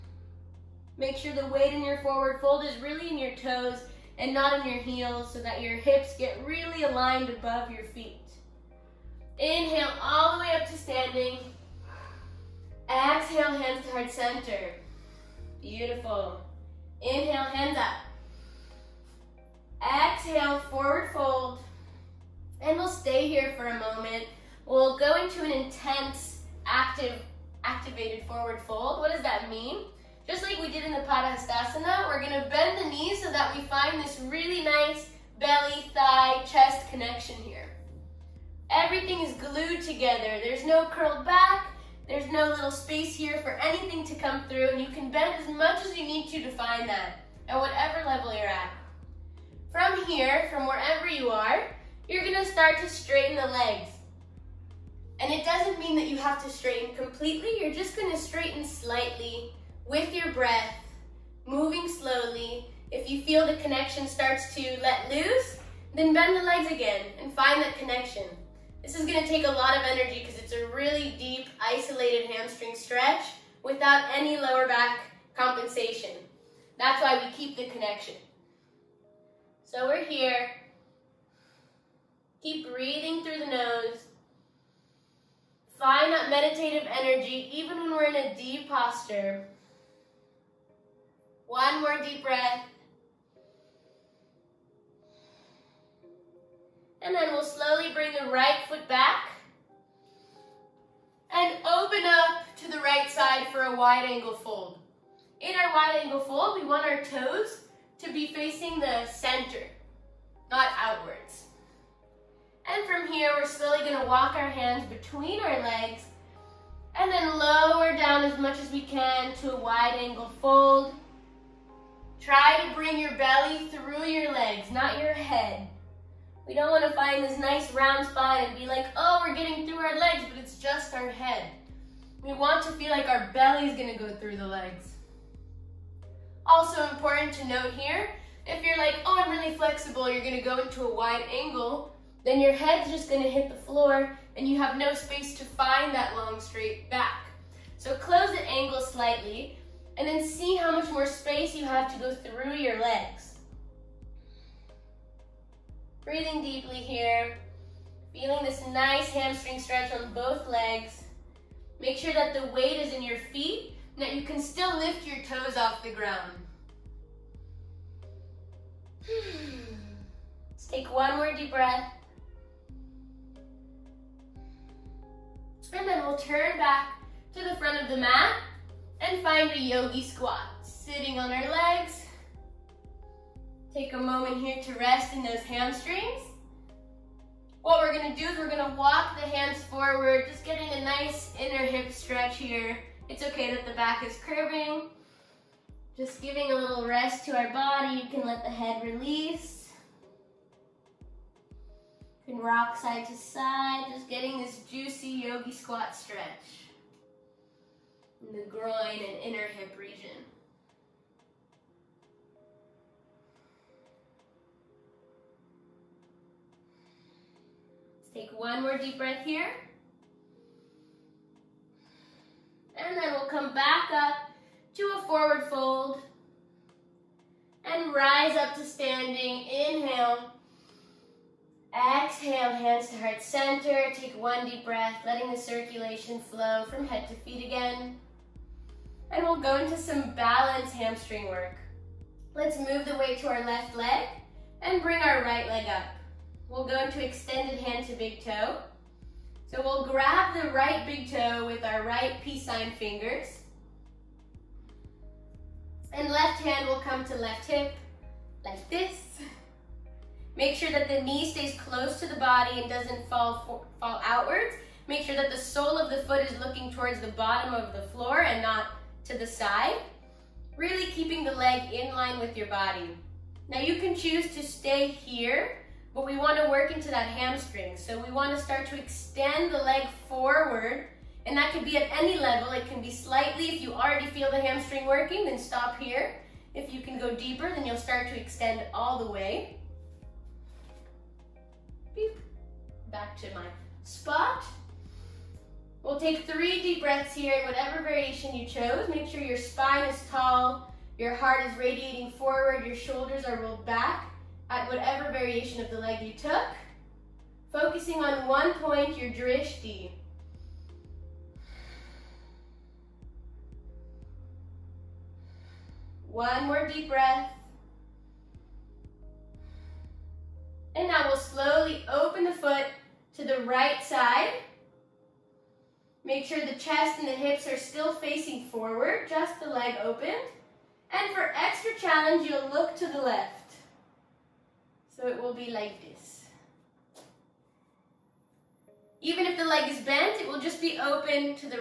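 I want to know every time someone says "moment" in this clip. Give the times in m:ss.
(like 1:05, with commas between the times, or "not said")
0:23, 3:03.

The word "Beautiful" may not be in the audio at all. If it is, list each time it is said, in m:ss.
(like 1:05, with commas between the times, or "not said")
0:15.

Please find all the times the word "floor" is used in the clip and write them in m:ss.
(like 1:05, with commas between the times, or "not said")
2:23, 4:27.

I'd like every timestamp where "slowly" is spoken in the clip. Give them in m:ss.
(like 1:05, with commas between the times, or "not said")
1:01, 1:37, 1:53, 5:21.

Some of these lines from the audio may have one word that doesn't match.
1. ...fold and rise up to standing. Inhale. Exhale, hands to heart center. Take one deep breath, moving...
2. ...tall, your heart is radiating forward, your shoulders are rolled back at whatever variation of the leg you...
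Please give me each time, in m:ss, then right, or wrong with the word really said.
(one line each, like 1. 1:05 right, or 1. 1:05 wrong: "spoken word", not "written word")
1. 3:45 wrong: "letting", not "moving"
2. 5:00 right.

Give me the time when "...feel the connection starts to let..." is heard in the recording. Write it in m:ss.
1:03.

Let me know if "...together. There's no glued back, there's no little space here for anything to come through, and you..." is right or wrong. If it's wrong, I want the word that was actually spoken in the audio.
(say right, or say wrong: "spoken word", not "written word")
wrong: "curled", not "glued".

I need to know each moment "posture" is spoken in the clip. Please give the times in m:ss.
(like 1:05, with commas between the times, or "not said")
1:28.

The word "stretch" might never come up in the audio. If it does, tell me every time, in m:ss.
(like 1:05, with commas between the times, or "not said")
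1:12, 2:39, 3:11, 3:25.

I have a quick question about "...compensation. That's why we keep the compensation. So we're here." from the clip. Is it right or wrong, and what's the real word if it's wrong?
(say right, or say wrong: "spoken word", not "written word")
wrong: "connection", not "compensation".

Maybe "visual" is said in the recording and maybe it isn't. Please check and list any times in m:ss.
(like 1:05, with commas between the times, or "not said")
not said.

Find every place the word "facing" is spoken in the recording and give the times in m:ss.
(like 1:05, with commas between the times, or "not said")
1:48, 5:27.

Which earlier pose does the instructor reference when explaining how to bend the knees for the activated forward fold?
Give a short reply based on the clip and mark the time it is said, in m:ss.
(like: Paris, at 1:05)
Padastasana, at 0:31.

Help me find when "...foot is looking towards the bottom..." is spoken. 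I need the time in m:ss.
4:26.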